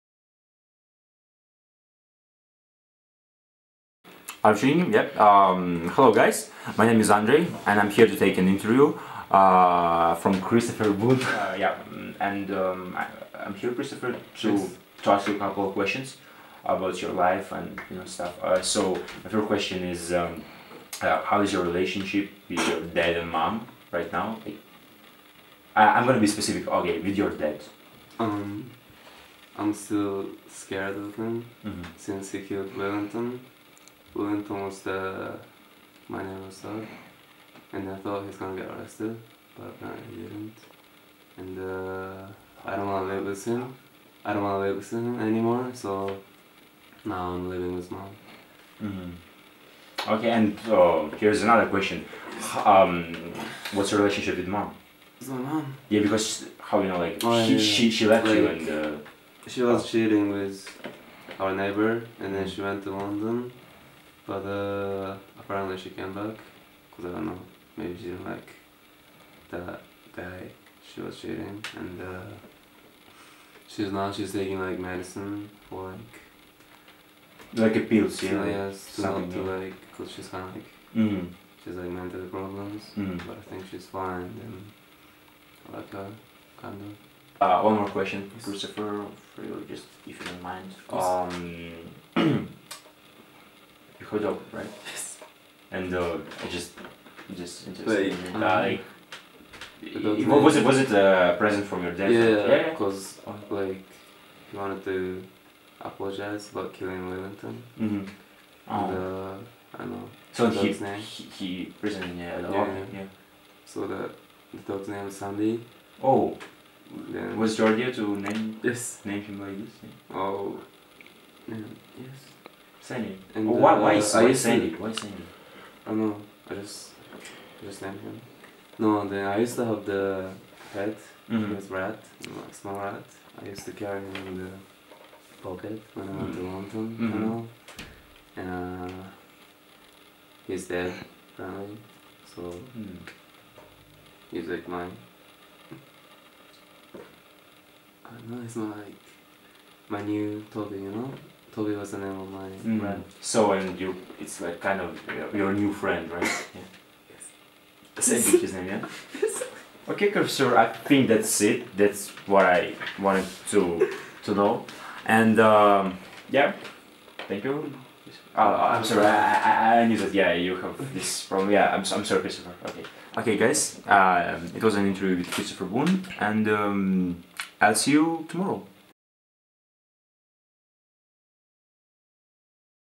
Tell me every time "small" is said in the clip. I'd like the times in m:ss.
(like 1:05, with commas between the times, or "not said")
2:12.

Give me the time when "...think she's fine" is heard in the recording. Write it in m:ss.
1:23.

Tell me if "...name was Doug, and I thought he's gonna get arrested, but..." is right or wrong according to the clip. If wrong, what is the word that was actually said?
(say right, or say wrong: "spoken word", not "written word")
right.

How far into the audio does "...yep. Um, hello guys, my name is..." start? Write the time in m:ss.
0:04.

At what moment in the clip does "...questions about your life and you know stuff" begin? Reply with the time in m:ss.
0:15.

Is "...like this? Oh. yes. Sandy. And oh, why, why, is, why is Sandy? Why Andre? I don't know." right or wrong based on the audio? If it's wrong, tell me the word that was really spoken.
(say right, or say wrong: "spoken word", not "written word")
wrong: "Sandy", not "Andre".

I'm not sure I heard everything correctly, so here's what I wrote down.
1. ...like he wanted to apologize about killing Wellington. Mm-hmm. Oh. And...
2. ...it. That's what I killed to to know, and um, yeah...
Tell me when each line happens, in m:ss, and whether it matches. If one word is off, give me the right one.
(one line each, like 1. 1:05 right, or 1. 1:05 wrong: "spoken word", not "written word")
1. 1:43 right
2. 2:41 wrong: "wanted", not "killed".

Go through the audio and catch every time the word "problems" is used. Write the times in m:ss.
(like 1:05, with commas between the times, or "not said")
1:22, 2:51.